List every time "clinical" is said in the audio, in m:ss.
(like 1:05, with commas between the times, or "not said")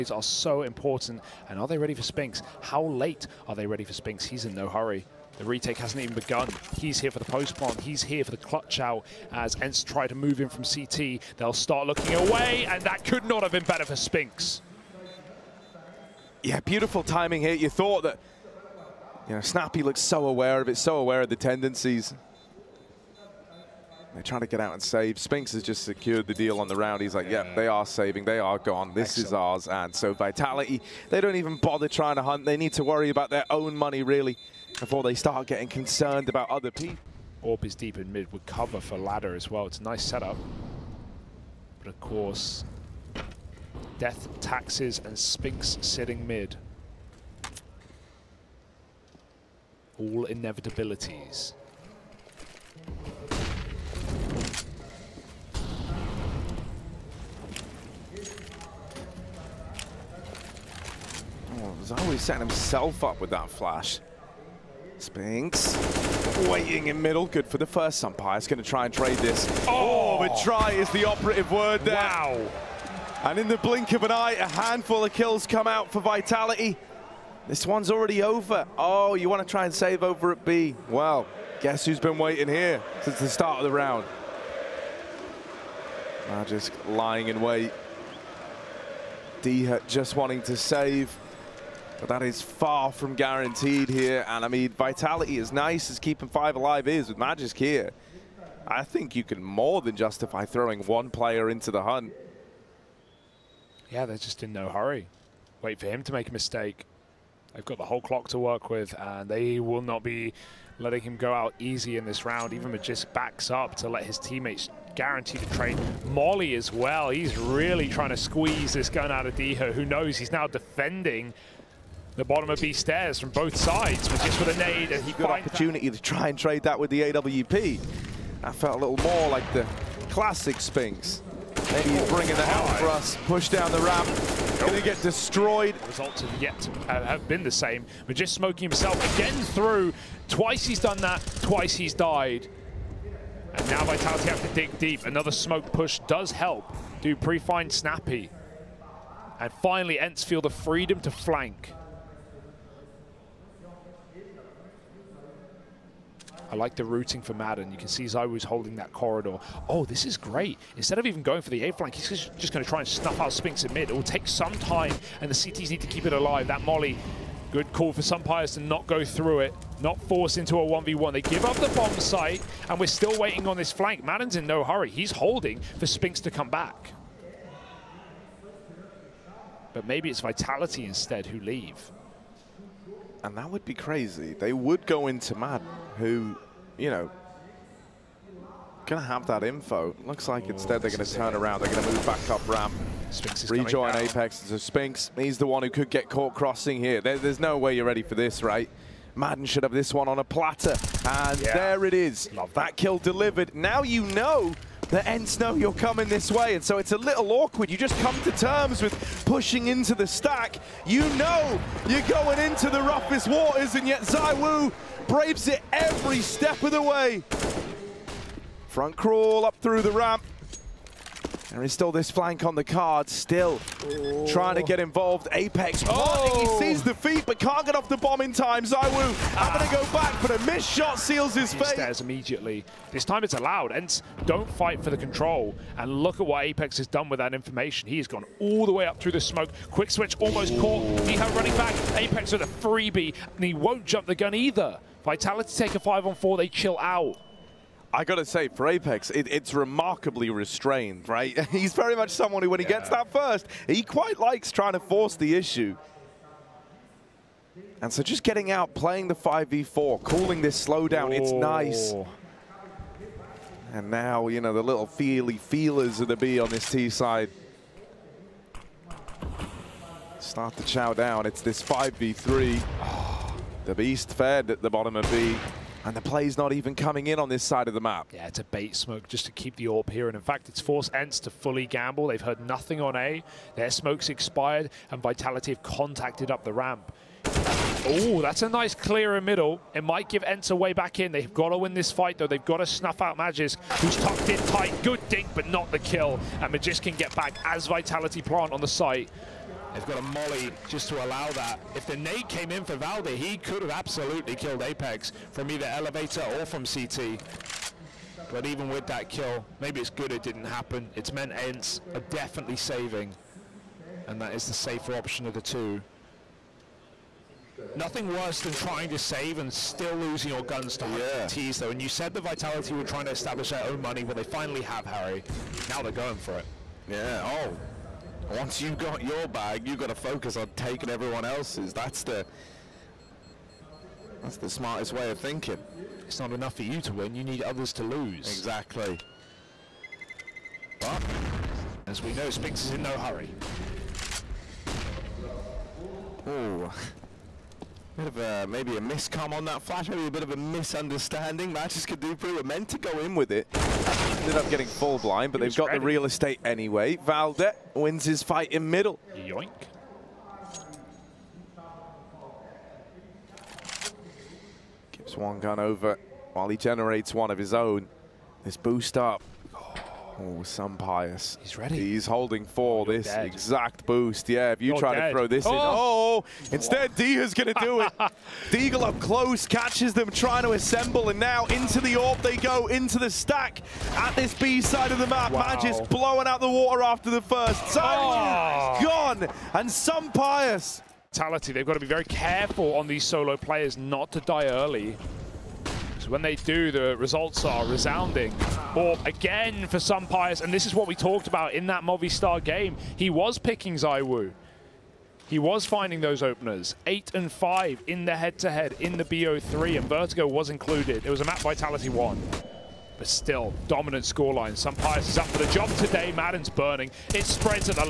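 not said.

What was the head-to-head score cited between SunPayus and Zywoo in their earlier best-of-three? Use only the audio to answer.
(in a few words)
8 and 5.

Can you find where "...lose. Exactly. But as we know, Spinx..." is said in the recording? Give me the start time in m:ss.
5:37.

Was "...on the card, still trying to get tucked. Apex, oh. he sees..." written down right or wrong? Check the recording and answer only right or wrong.
wrong.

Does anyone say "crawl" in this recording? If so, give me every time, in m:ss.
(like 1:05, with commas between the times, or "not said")
3:38.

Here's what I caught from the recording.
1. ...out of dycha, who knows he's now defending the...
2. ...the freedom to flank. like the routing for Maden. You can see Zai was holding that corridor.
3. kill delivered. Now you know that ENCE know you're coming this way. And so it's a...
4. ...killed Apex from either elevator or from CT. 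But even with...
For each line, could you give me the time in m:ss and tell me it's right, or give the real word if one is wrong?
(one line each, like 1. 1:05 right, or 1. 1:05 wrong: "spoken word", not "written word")
1. 1:59 right
2. 2:30 right
3. 3:22 right
4. 5:04 right.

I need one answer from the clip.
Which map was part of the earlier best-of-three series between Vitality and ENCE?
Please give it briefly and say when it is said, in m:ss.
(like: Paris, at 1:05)
Vertigo, at 6:49.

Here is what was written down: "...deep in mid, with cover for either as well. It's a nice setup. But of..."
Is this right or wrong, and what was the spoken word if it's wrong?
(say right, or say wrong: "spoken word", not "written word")
wrong: "ladder", not "either".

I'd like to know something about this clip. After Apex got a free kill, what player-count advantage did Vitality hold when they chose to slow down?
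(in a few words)
5 on 4.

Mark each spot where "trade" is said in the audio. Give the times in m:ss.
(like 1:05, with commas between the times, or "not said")
1:08, 1:55, 2:06.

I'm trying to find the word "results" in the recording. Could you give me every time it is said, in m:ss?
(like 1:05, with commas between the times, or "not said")
2:15, 6:36.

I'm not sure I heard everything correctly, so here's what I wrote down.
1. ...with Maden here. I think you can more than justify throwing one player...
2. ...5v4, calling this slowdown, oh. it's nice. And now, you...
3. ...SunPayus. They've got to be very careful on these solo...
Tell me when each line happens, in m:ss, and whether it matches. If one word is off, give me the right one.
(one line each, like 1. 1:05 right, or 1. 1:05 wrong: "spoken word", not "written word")
1. 1:37 wrong: "Magisk", not "Maden"
2. 4:19 right
3. 6:29 right.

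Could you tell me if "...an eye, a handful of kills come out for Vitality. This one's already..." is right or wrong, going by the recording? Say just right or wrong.
right.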